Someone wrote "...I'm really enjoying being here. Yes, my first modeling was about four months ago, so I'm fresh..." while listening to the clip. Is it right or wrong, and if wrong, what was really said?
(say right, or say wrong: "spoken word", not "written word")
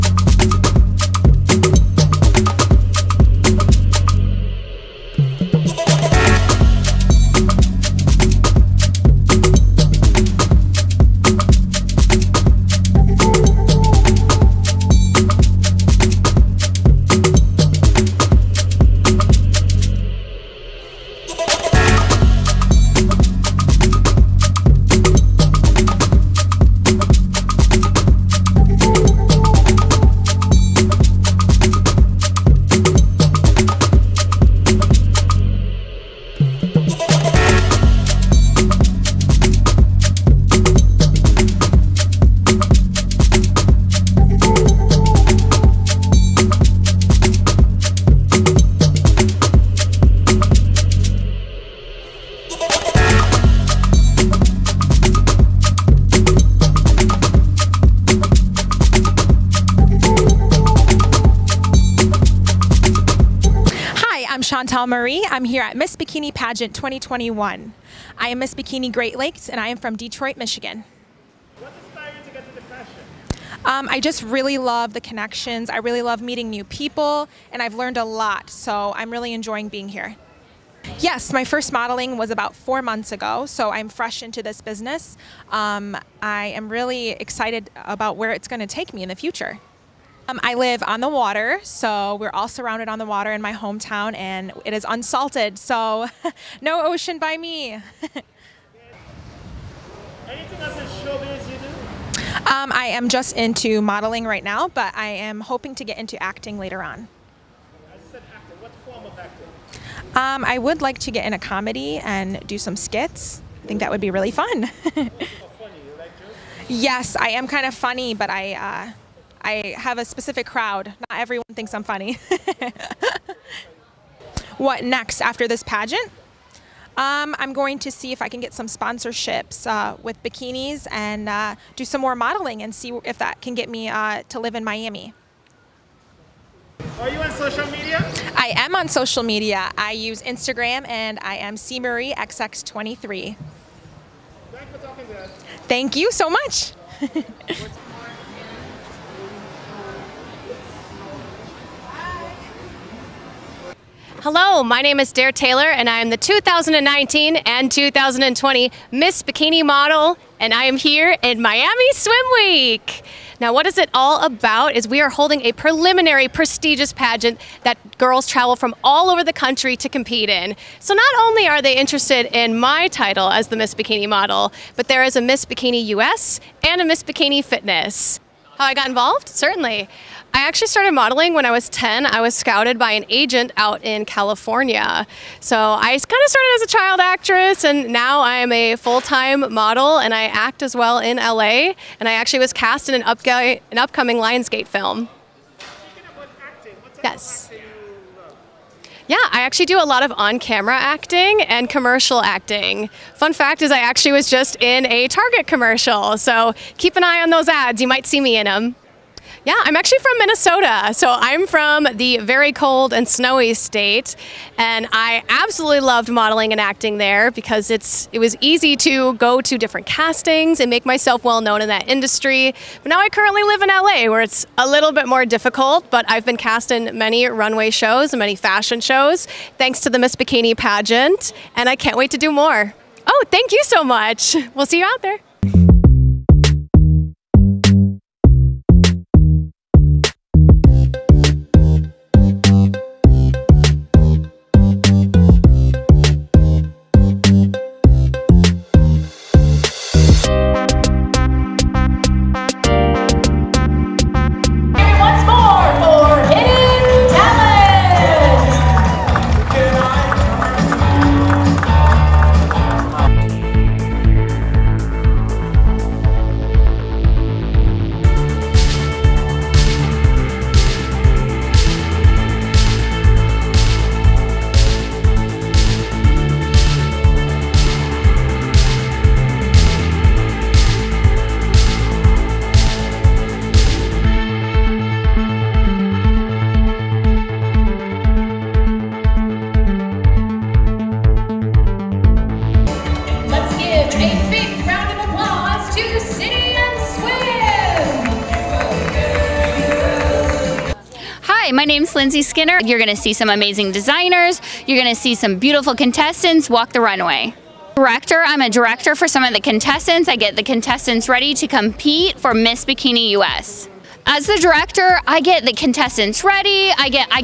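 right.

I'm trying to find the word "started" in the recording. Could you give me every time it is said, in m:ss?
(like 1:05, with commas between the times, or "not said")
3:00, 3:06.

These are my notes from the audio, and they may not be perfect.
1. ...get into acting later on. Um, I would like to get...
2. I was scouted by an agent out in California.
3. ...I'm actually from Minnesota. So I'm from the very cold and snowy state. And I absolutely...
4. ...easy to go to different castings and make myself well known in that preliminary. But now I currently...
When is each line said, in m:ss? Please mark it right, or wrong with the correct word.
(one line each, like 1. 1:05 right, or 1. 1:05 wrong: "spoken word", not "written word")
1. 1:45 right
2. 3:02 right
3. 3:29 right
4. 3:38 wrong: "industry", not "preliminary".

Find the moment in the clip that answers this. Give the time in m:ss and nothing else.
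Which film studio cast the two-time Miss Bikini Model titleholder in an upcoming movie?
3:14.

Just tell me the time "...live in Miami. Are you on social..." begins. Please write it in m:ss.
2:14.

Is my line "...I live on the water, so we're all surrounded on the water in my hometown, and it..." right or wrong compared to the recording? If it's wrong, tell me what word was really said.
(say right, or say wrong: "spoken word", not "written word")
right.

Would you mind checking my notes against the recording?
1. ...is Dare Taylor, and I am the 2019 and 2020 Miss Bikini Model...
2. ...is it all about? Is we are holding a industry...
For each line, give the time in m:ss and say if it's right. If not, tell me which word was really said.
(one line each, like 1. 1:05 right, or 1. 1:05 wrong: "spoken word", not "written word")
1. 2:34 right
2. 2:43 wrong: "preliminary", not "industry".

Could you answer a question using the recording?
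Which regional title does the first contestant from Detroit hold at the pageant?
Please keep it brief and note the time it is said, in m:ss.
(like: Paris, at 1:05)
Miss Bikini Great Lakes, at 1:08.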